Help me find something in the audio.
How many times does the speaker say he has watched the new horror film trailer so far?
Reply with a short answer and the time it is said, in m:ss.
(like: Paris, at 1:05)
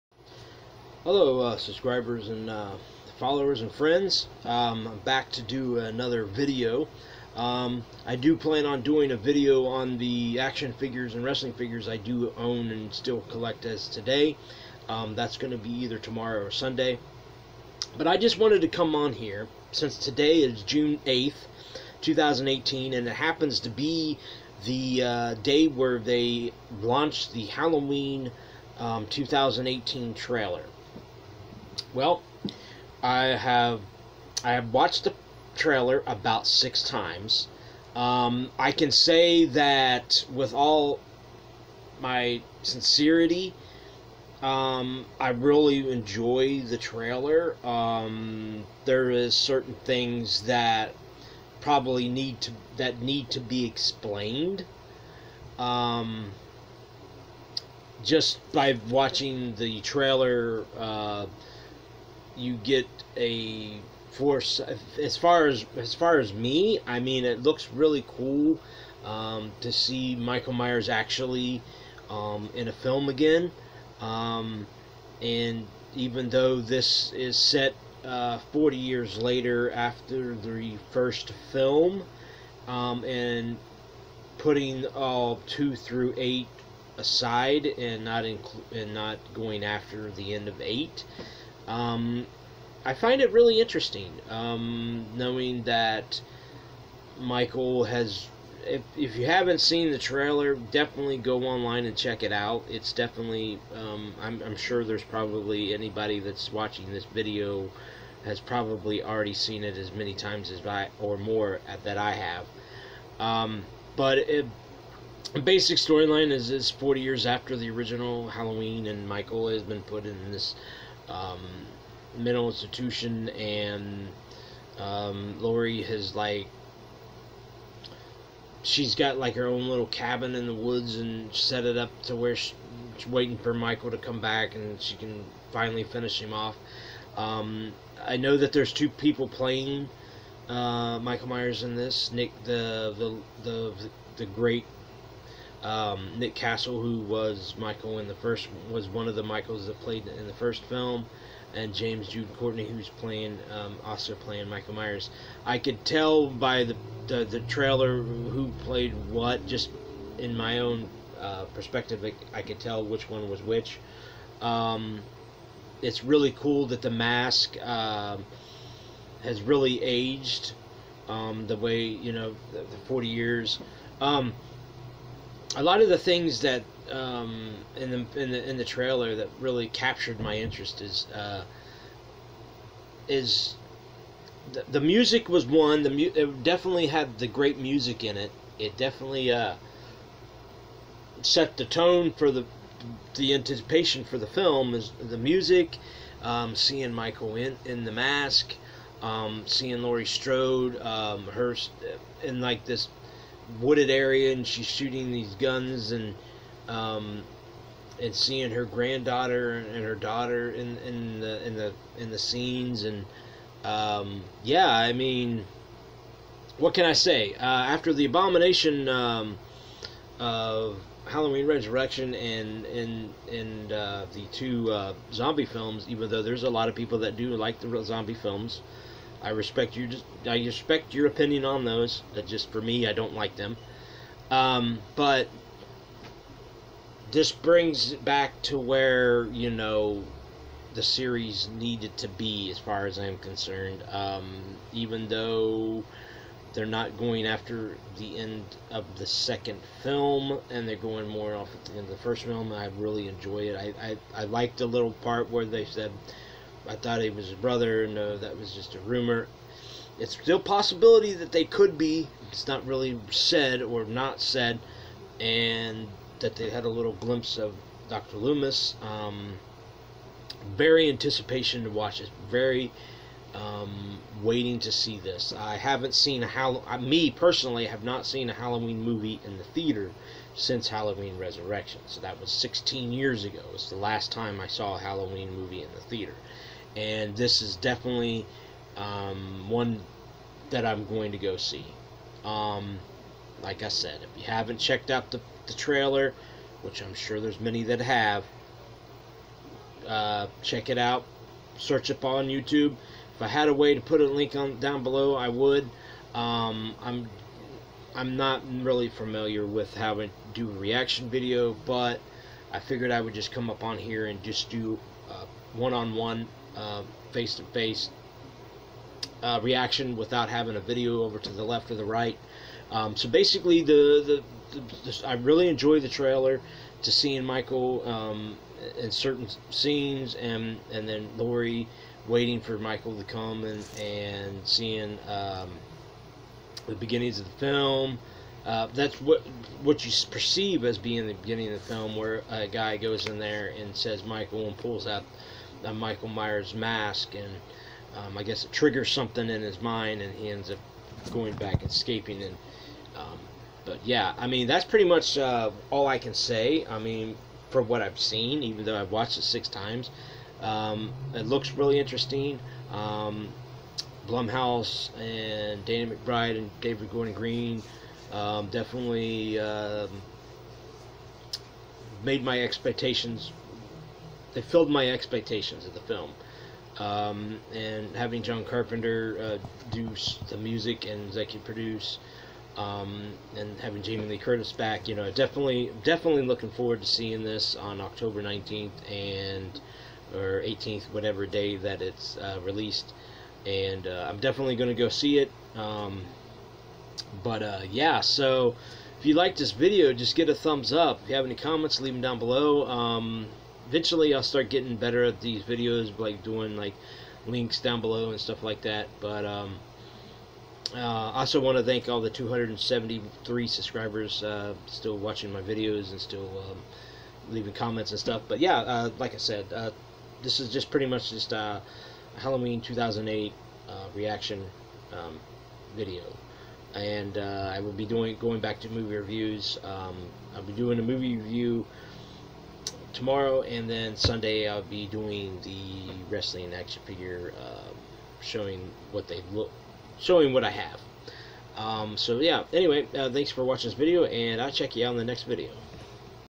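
6, at 0:36.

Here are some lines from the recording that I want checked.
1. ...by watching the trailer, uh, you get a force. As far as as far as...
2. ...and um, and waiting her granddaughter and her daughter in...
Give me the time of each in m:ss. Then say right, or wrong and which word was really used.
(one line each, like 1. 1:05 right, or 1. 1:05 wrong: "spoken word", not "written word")
1. 0:58 right
2. 3:25 wrong: "seeing", not "waiting".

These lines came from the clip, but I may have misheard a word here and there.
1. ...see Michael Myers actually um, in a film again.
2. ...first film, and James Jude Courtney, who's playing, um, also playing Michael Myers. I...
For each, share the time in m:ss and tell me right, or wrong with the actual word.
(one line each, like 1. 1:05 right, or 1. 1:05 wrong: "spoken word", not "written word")
1. 1:09 right
2. 2:30 right.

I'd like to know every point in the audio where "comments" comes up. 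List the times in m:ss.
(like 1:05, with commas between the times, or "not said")
6:41, 6:57.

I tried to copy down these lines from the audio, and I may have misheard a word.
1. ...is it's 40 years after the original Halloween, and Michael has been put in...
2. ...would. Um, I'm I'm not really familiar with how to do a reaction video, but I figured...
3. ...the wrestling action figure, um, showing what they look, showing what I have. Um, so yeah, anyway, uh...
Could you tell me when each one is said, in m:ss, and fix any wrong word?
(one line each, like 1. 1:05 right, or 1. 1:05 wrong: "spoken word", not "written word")
1. 1:56 right
2. 5:05 right
3. 7:15 right.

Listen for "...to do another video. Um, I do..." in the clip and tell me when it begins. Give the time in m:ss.
0:05.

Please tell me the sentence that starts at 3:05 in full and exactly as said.
The mu- it definitely had the great music in it.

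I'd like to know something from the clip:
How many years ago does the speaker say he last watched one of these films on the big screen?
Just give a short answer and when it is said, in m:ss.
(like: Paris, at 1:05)
16 years, at 4:42.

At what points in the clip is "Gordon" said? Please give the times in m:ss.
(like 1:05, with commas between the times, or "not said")
6:06.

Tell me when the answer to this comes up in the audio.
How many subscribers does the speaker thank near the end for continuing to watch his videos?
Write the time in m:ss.
6:52.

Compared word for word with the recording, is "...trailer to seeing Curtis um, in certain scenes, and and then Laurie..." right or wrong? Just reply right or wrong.
wrong.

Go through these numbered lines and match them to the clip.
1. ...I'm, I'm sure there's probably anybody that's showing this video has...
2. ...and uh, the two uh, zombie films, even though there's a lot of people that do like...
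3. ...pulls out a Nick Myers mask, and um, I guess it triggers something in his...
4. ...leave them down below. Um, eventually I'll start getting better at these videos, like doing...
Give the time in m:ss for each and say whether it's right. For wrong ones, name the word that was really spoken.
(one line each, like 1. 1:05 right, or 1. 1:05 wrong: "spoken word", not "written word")
1. 1:44 wrong: "watching", not "showing"
2. 3:43 right
3. 5:44 wrong: "Michael", not "Nick"
4. 6:41 right.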